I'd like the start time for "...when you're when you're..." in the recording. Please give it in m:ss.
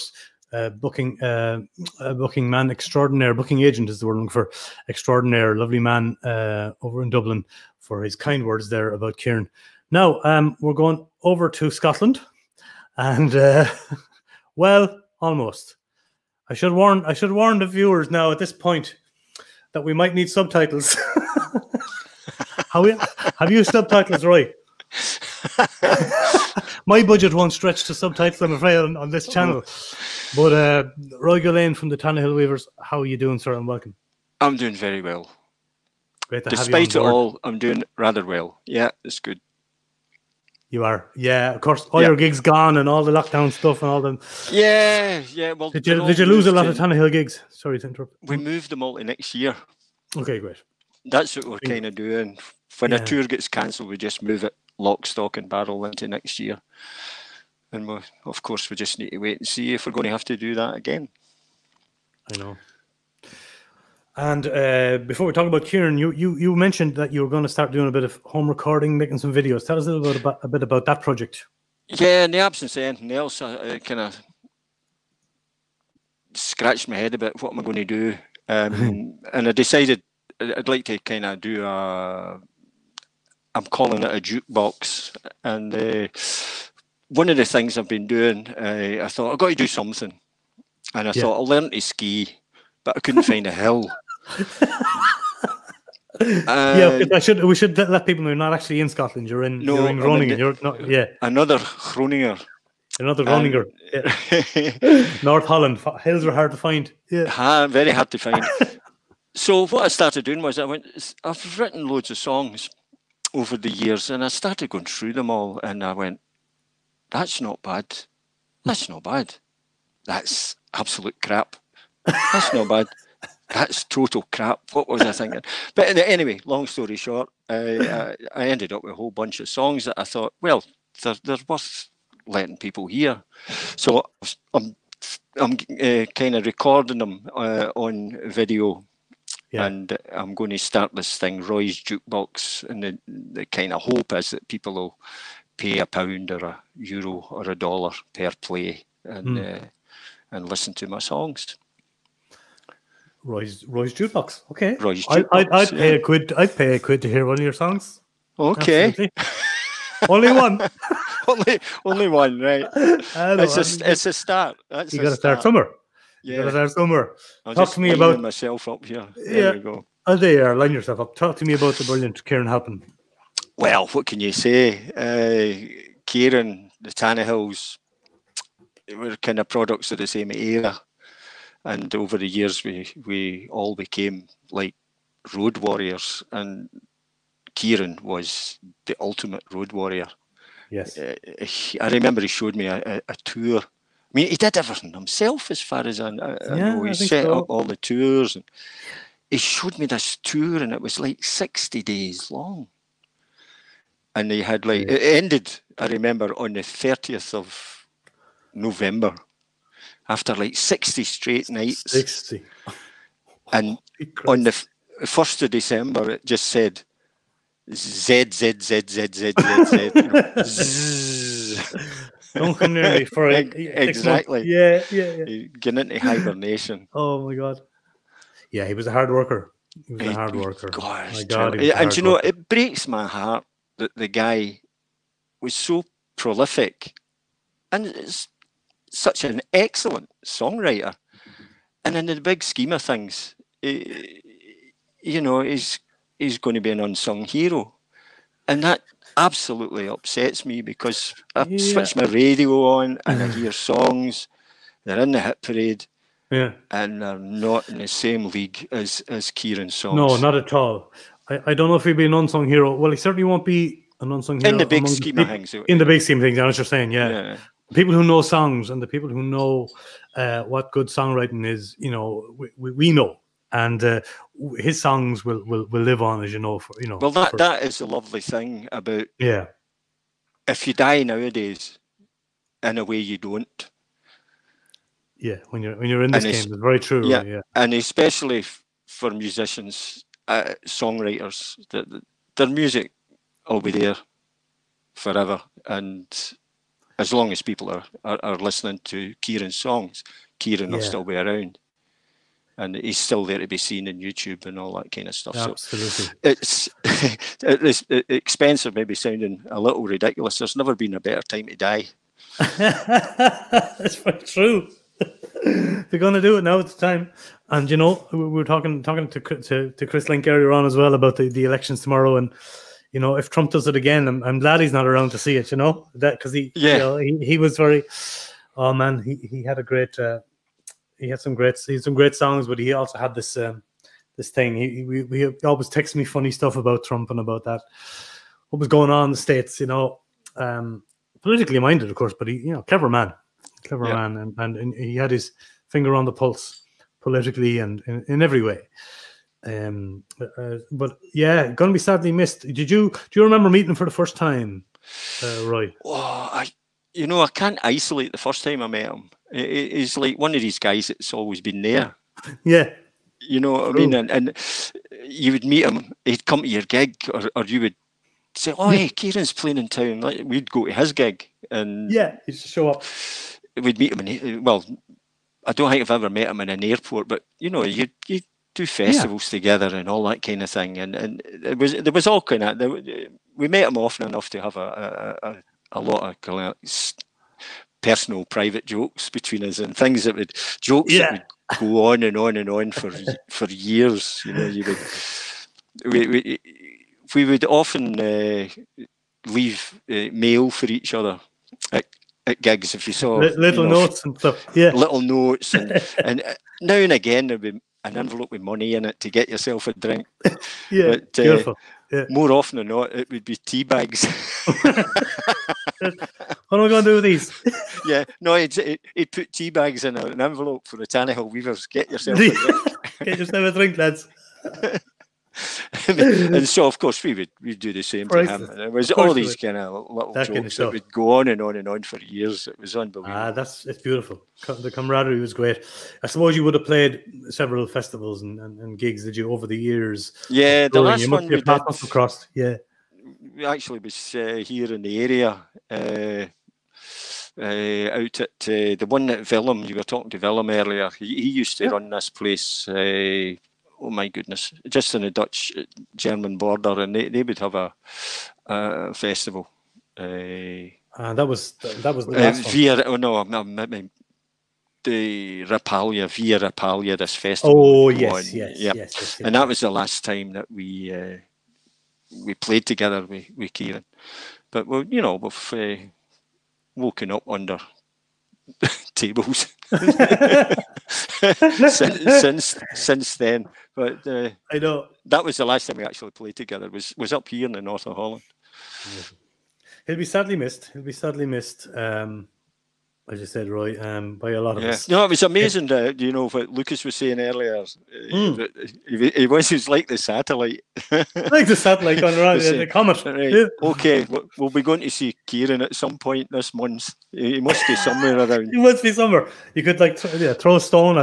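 4:45.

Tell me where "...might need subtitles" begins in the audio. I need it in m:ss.
0:19.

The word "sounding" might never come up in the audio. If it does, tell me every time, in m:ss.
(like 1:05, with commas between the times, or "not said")
5:08.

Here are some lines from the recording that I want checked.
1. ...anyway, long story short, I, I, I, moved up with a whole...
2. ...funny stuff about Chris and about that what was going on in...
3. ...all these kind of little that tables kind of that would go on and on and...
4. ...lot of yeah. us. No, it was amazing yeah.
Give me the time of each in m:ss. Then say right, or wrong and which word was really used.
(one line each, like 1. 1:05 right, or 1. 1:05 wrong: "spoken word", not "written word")
1. 2:05 wrong: "ended", not "moved"
2. 5:36 wrong: "Trump", not "Chris"
3. 7:08 wrong: "jokes", not "tables"
4. 8:14 right.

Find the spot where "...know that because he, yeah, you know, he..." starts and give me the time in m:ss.
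5:25.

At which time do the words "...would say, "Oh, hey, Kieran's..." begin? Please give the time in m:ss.
6:07.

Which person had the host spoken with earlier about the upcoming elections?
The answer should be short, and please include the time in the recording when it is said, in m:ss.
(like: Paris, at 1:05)
Chris Link, at 5:19.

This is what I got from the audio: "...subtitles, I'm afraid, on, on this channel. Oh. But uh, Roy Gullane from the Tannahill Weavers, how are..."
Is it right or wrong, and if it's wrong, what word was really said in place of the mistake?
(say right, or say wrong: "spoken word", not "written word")
right.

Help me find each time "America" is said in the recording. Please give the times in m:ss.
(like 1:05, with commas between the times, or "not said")
not said.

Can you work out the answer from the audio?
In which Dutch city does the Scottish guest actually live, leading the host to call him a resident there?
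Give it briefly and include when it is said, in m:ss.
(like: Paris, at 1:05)
Groningen, at 1:39.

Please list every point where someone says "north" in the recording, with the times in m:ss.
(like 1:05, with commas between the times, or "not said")
1:45, 8:07.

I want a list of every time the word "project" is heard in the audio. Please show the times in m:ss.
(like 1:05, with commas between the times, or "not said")
1:11.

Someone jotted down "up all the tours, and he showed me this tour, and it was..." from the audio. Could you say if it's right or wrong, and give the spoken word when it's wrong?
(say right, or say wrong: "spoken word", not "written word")
right.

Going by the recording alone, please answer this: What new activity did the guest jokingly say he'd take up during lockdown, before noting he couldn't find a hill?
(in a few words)
Ski.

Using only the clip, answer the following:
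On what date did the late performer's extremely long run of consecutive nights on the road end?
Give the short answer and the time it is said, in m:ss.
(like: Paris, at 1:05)
30 November, at 3:26.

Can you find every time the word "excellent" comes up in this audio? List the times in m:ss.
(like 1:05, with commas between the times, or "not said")
3:59.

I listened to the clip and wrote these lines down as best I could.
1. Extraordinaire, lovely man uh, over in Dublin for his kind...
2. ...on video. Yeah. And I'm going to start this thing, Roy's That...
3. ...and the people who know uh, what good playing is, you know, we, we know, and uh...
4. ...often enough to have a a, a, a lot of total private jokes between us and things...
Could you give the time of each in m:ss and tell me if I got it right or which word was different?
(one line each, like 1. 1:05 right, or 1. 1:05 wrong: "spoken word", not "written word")
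1. 0:04 right
2. 2:17 wrong: "Jukebox", not "That"
3. 4:28 wrong: "songwriting", not "playing"
4. 6:23 wrong: "personal", not "total".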